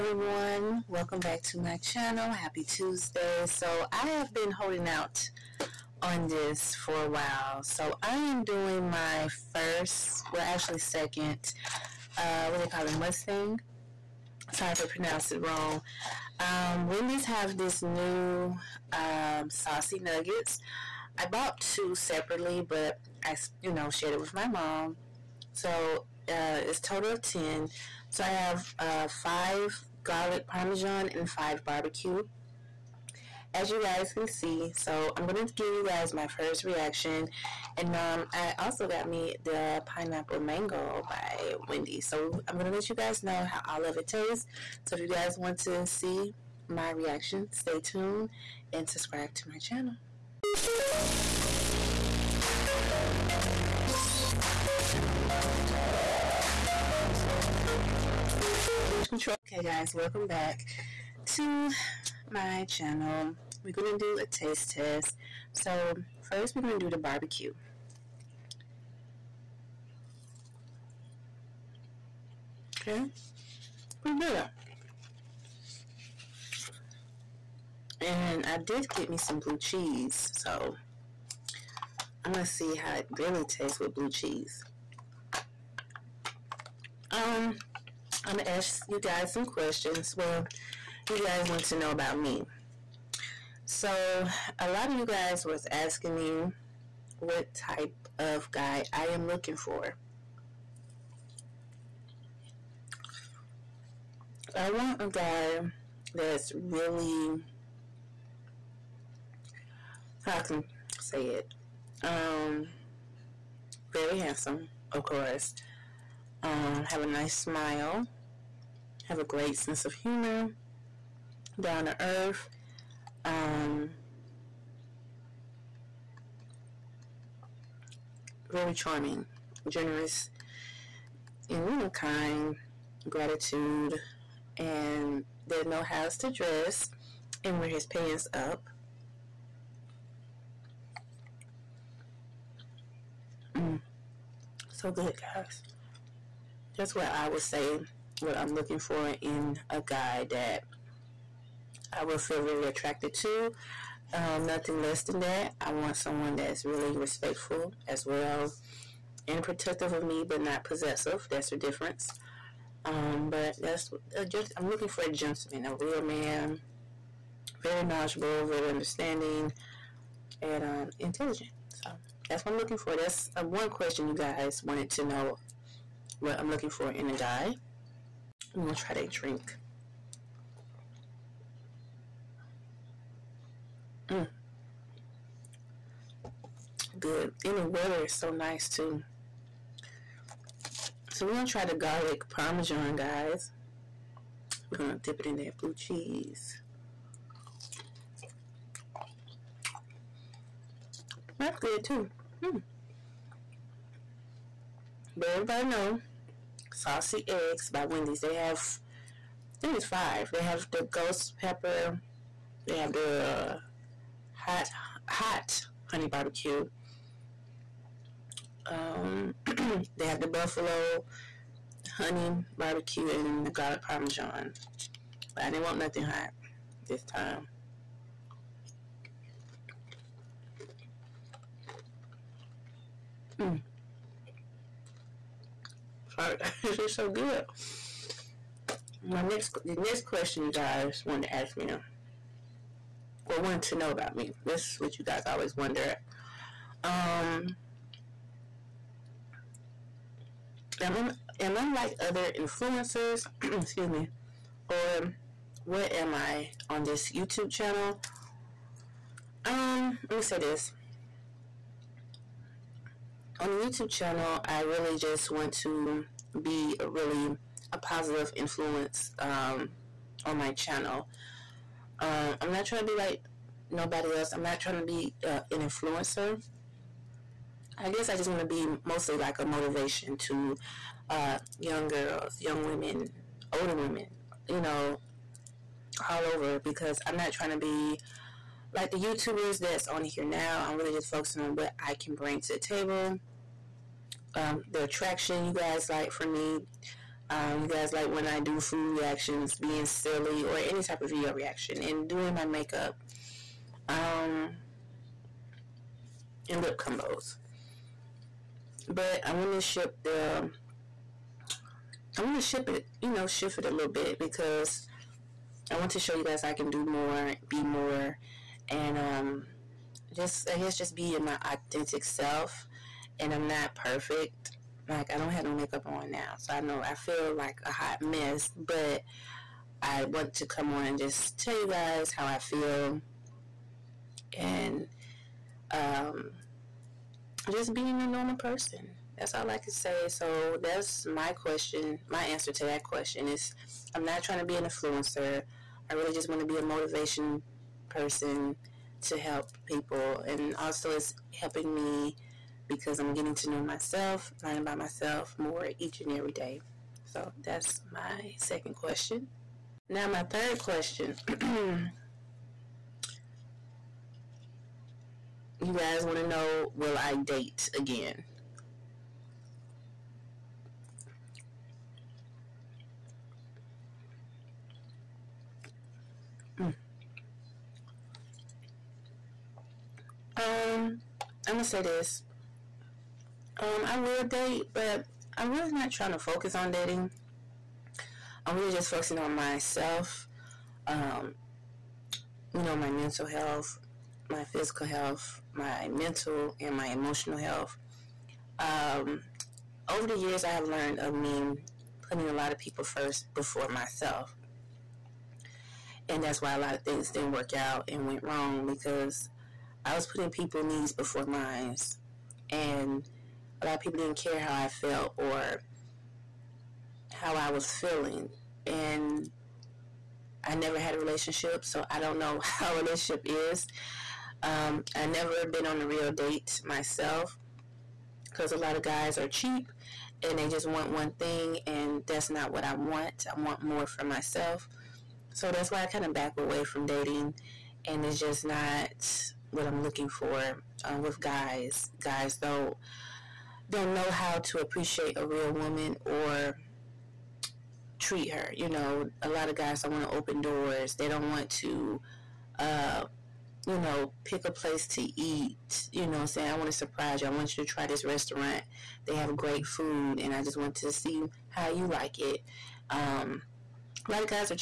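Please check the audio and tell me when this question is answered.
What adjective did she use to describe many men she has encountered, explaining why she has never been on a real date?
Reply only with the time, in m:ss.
7:09.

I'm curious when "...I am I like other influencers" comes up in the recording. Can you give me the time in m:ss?
4:10.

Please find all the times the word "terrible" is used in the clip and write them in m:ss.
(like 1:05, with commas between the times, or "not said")
not said.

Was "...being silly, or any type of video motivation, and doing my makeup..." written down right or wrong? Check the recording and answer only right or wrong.
wrong.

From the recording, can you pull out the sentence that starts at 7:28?
You know, a lot of guys don't want to open doors.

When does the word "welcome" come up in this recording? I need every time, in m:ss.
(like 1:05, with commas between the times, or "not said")
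0:00, 0:59.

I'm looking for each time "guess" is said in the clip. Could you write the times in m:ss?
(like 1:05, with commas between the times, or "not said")
4:37, 5:20.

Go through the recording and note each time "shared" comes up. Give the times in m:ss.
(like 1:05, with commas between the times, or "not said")
0:23.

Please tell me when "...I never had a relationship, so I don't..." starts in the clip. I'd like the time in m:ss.
7:00.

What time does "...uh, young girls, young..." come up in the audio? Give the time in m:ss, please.
4:41.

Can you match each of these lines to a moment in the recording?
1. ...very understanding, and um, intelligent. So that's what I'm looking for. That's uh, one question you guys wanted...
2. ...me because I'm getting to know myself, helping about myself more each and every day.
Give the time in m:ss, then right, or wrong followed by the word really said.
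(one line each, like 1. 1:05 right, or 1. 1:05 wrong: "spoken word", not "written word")
1. 2:48 right
2. 5:51 wrong: "learning", not "helping".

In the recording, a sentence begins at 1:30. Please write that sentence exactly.
Well, you guys want to know about me.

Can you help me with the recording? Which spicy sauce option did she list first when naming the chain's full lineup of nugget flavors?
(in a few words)
ghost pepper.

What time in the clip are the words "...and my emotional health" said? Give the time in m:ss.
6:36.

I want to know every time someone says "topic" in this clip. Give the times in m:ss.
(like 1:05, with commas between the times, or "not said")
not said.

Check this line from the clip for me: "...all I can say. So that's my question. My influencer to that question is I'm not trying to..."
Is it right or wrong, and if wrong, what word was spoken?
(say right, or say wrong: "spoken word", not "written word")
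wrong: "answer", not "influencer".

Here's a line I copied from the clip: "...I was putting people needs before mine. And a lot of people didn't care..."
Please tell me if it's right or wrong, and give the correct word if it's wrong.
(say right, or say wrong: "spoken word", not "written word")
right.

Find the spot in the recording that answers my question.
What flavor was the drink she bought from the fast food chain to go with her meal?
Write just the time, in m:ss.
0:39.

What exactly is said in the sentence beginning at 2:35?
I want someone that's really respectful as well and protective of me, but not possessive.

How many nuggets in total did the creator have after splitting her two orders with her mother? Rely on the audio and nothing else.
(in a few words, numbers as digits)
10.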